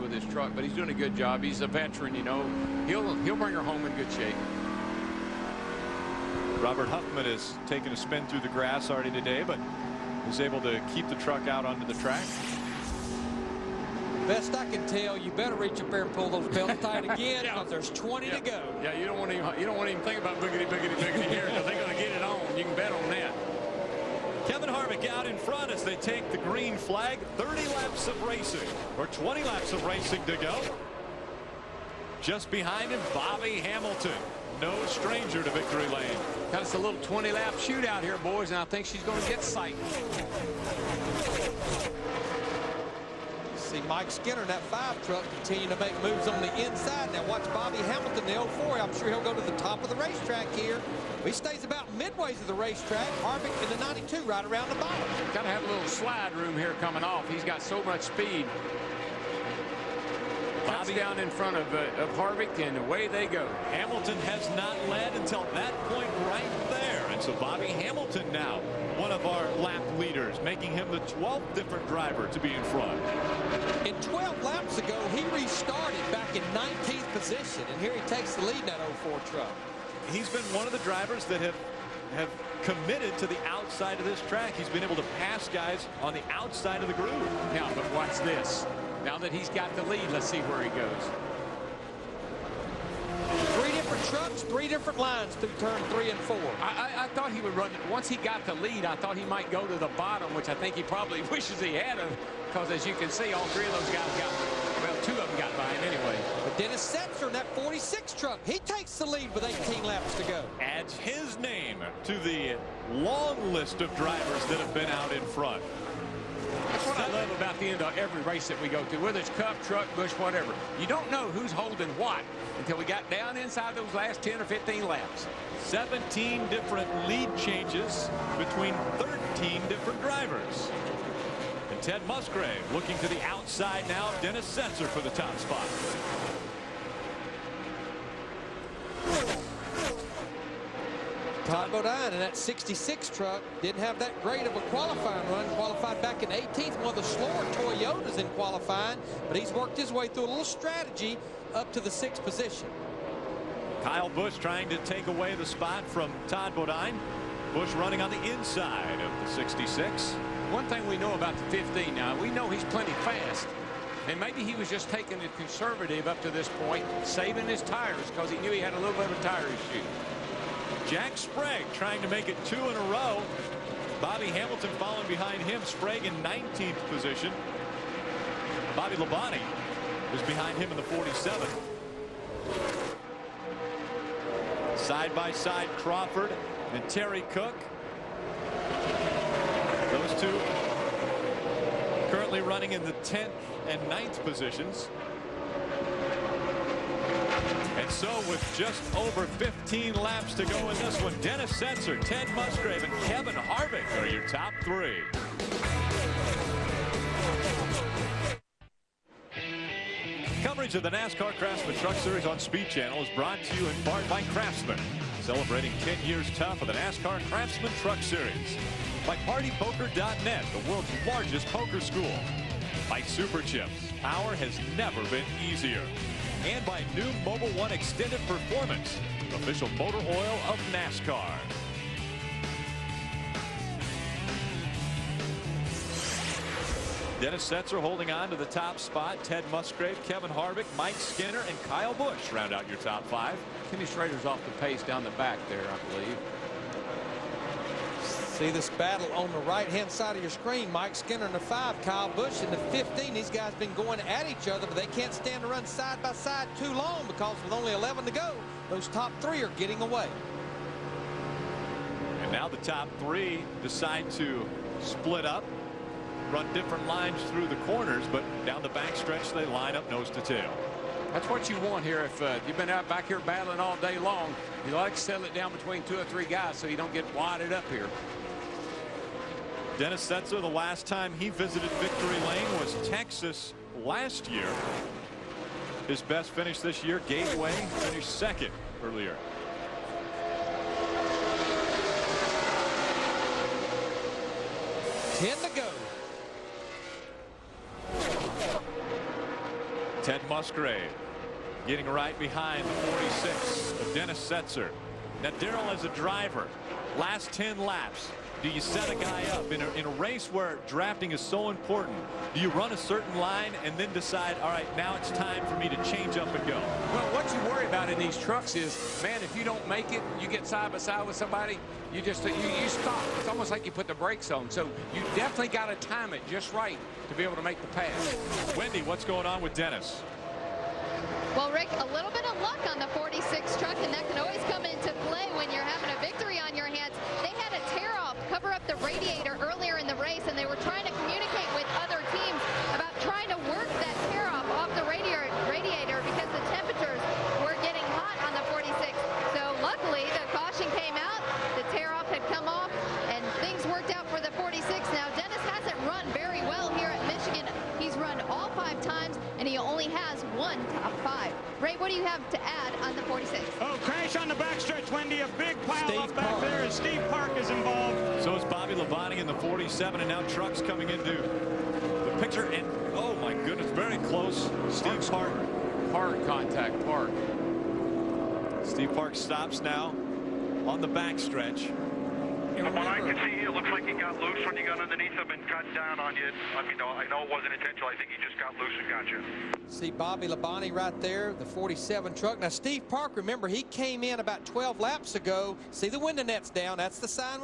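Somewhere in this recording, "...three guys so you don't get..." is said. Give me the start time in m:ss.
4:36.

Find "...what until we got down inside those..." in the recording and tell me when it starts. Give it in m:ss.
2:01.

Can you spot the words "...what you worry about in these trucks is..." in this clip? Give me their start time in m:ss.
5:17.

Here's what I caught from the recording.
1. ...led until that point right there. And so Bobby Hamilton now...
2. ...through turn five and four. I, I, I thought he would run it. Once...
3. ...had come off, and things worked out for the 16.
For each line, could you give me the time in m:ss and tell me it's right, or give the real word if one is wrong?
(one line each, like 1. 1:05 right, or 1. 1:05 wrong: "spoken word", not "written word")
1. 1:04 right
2. 1:35 wrong: "three", not "five"
3. 5:52 wrong: "46", not "16".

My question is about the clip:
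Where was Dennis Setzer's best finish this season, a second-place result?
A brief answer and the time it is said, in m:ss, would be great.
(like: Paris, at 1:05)
Gateway, at 4:47.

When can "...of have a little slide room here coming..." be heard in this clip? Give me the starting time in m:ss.
0:55.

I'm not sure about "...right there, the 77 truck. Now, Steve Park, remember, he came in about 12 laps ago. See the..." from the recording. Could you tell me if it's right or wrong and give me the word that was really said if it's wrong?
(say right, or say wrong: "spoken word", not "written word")
wrong: "47", not "77".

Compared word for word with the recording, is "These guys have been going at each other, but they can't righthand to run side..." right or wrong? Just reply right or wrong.
wrong.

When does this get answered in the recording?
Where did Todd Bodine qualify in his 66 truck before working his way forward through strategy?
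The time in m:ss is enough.
2:26.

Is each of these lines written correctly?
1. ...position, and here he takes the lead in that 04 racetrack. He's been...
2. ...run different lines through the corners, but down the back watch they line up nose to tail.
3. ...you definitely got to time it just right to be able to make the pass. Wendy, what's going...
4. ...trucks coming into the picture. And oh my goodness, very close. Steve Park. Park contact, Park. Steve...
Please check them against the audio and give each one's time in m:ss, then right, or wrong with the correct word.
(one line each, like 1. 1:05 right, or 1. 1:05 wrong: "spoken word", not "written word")
1. 1:17 wrong: "truck", not "racetrack"
2. 4:26 wrong: "stretch", not "watch"
3. 5:24 right
4. 6:10 right.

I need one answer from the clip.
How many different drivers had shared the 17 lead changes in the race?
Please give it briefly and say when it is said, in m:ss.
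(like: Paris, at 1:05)
13, at 2:08.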